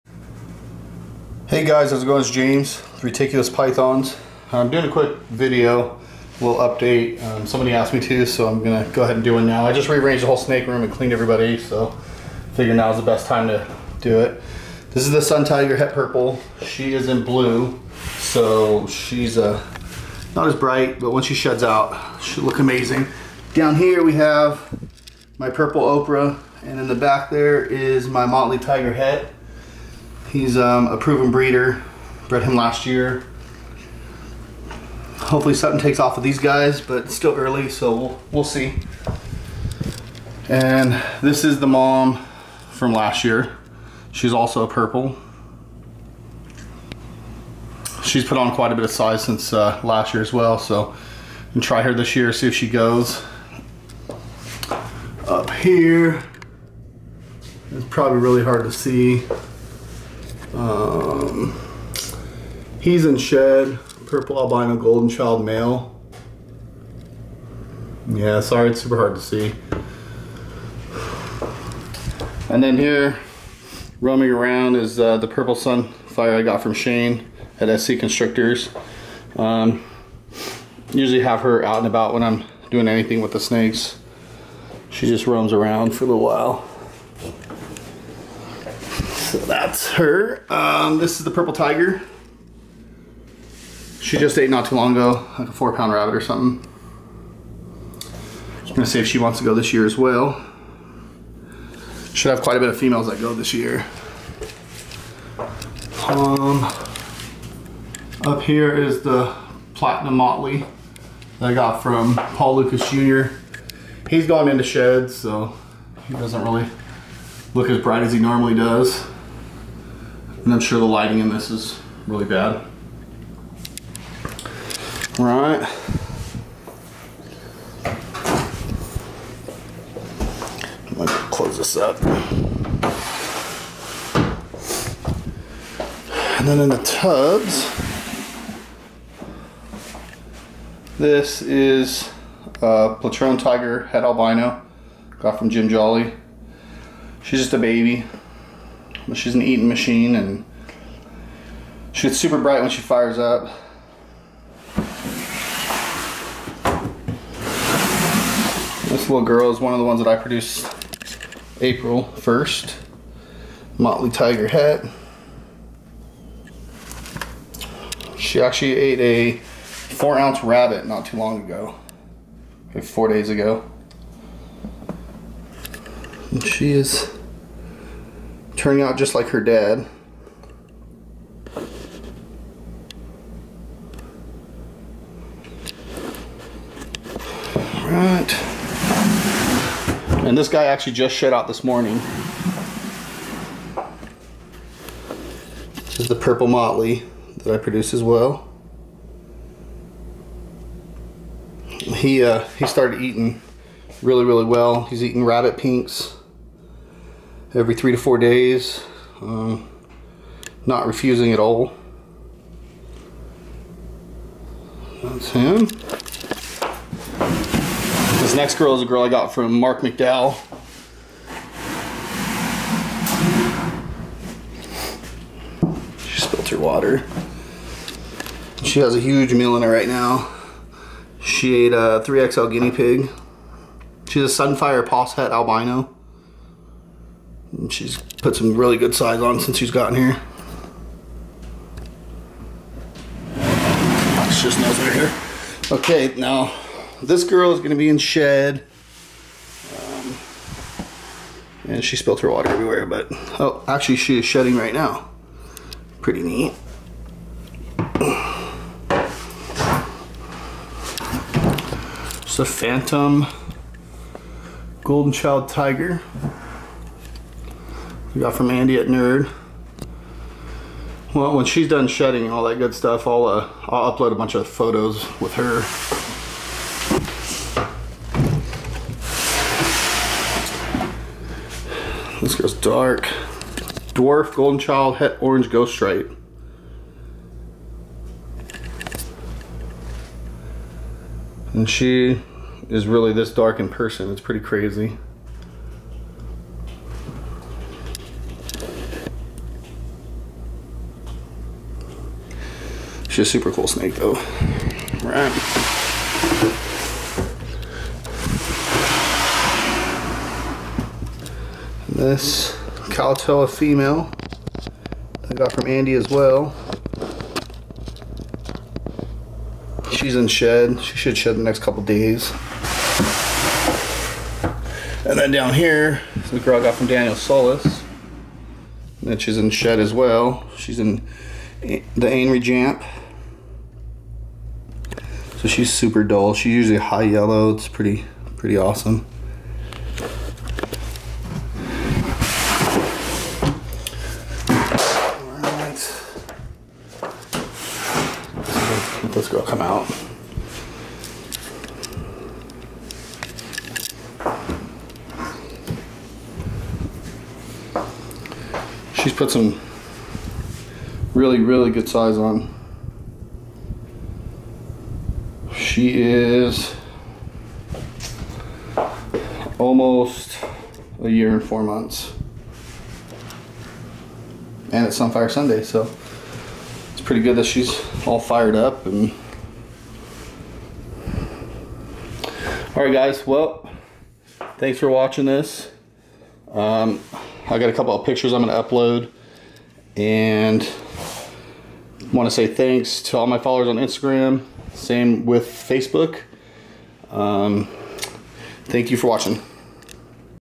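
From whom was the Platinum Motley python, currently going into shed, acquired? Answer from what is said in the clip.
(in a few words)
Paul Lucas Jr.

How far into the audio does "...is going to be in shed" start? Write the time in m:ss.
4:07.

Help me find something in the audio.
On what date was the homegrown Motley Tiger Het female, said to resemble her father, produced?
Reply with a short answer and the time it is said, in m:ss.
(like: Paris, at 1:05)
April 1st, at 2:41.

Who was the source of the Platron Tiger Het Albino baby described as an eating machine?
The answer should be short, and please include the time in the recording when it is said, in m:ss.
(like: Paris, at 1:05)
Jim Jolly, at 2:25.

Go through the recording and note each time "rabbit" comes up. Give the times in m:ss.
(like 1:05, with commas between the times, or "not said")
1:35, 2:50, 3:25.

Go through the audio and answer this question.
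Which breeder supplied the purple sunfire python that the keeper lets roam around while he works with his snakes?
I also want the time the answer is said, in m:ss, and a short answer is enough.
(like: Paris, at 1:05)
Shane at SC Constrictors, at 1:16.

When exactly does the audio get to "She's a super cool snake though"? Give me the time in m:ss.
5:03.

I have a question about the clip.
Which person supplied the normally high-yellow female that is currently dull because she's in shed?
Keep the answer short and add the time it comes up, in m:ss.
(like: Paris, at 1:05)
Daniel Solis, at 5:26.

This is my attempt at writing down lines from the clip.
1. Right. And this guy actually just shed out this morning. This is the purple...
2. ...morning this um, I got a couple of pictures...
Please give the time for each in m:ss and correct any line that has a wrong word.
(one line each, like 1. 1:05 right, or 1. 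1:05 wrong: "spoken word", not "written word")
1. 3:07 right
2. 6:24 wrong: "watching", not "morning".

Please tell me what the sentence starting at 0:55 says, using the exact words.
Up here, it's probably really hard to see.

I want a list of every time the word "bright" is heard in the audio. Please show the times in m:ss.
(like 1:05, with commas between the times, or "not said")
0:20, 1:57, 2:32.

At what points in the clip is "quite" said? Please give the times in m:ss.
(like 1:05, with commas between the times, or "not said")
0:48, 1:42.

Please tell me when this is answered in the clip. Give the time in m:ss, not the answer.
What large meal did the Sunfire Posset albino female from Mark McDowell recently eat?
3:52.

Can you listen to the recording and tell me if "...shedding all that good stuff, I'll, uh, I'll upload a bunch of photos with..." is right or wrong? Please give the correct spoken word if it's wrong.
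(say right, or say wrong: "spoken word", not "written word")
right.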